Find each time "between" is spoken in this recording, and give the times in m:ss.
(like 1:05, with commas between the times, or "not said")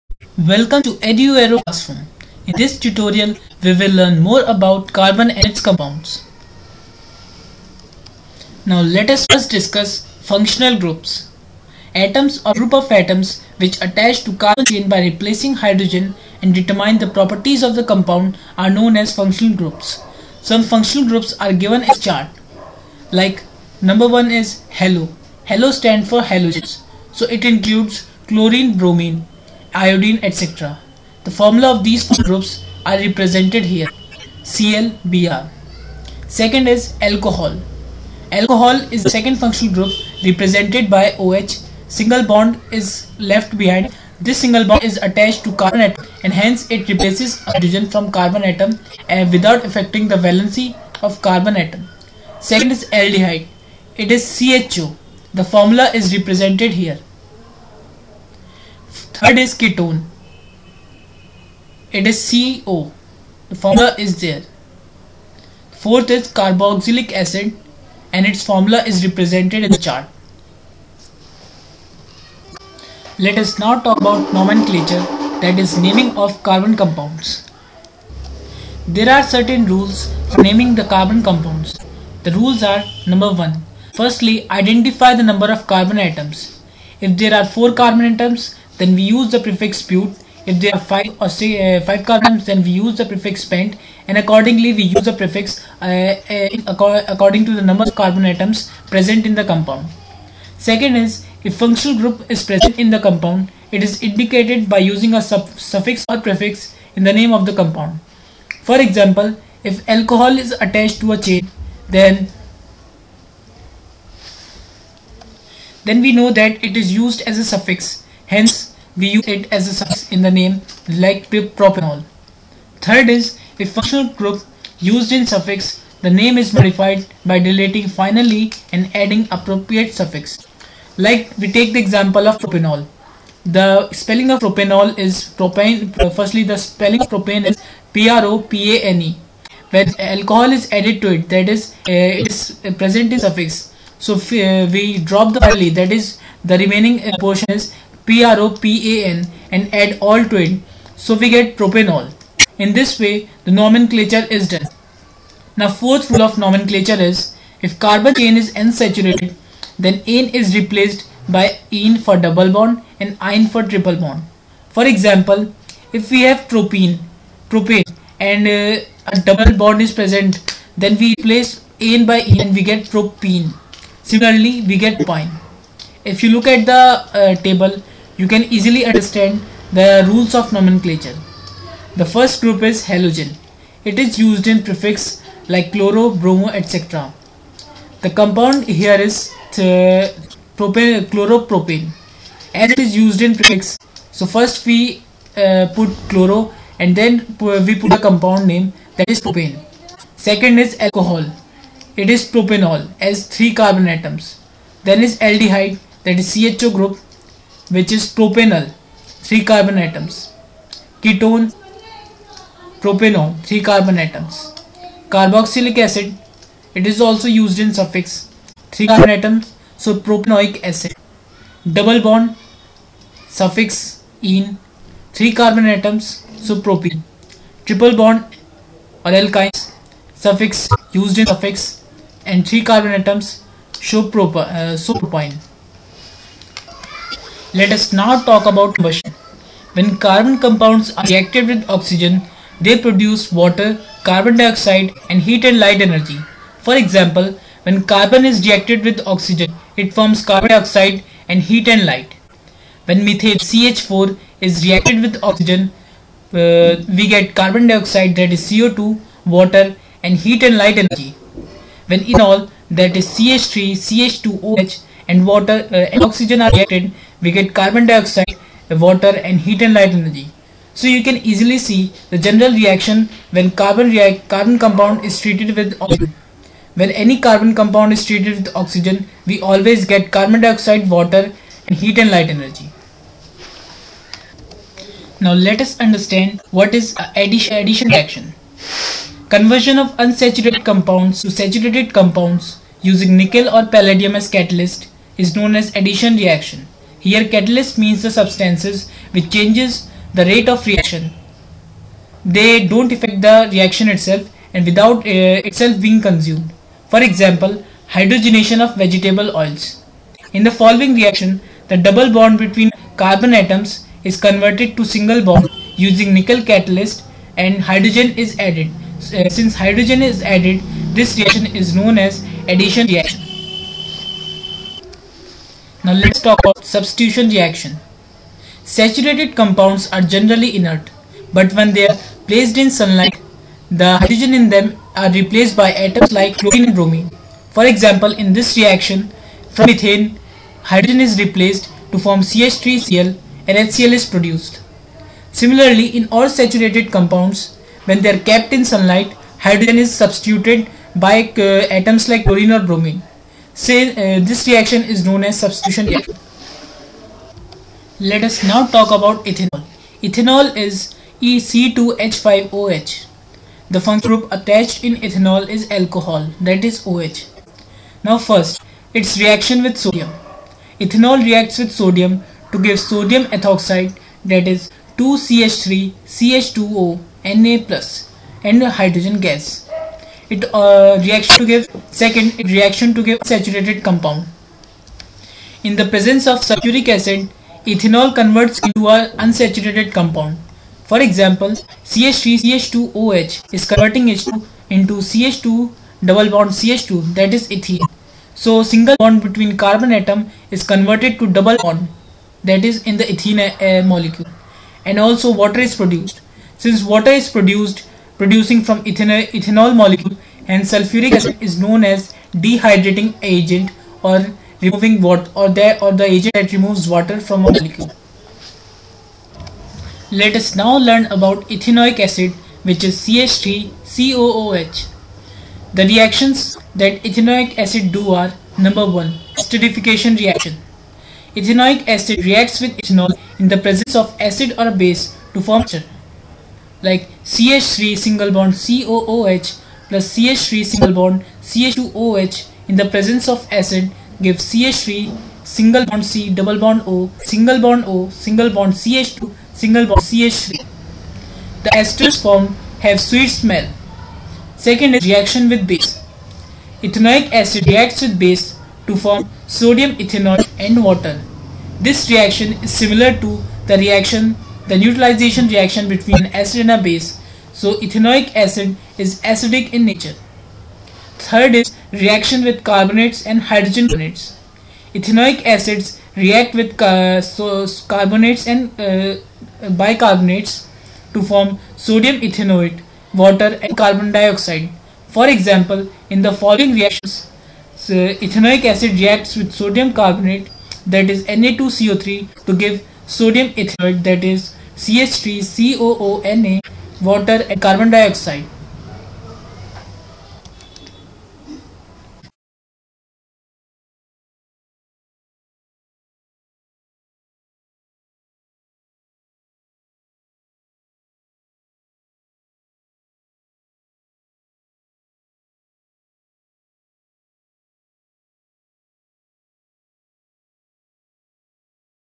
5:12, 6:39, 7:45.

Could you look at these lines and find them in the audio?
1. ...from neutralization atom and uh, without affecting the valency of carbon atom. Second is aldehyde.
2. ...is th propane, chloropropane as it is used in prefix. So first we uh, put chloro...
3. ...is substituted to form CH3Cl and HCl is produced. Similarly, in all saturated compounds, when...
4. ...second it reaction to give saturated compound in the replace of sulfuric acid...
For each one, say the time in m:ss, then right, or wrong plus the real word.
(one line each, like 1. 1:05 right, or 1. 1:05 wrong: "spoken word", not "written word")
1. 0:47 wrong: "carbon", not "neutralization"
2. 3:08 right
3. 5:41 wrong: "replaced", not "substituted"
4. 6:22 wrong: "presence", not "replace".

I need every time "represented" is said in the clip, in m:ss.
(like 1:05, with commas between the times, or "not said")
0:32, 0:40, 0:56, 1:09.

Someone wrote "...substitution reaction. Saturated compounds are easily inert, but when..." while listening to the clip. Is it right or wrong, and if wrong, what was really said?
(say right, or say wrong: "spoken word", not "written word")
wrong: "generally", not "easily".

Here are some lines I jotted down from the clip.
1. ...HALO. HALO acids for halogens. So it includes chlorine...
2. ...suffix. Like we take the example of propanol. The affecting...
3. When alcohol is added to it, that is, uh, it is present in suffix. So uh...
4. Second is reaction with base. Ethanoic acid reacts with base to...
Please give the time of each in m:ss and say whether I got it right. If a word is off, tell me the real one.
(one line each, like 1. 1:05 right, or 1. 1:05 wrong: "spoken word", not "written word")
1. 0:24 wrong: "stands", not "acids"
2. 2:09 wrong: "spelling", not "affecting"
3. 2:19 right
4. 7:34 right.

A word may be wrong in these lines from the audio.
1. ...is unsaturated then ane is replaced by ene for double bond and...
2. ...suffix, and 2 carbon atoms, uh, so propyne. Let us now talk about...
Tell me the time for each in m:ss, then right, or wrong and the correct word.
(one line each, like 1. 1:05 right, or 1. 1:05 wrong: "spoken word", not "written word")
1. 2:38 right
2. 3:51 wrong: "3", not "2".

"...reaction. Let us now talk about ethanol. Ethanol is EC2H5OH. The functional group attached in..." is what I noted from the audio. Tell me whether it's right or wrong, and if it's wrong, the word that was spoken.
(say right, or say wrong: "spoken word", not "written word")
right.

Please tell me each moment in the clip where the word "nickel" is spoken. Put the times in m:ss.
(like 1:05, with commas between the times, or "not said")
4:53, 5:16.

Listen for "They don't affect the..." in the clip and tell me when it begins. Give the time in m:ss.
5:02.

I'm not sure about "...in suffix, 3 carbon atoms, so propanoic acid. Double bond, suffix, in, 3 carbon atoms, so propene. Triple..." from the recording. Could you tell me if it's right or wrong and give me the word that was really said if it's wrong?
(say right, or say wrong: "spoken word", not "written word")
right.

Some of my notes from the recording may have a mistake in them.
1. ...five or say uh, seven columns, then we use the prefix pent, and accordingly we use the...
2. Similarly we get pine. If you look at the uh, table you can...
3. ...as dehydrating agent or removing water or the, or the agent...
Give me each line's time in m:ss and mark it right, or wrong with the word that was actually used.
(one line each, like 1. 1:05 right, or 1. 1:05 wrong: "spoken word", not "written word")
1. 1:30 wrong: "five", not "seven"
2. 2:54 right
3. 6:51 right.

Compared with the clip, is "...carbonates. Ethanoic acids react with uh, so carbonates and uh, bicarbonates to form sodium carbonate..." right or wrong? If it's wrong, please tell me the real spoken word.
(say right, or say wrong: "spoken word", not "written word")
wrong: "ethanoate", not "carbonate".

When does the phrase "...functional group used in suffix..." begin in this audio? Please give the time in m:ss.
2:03.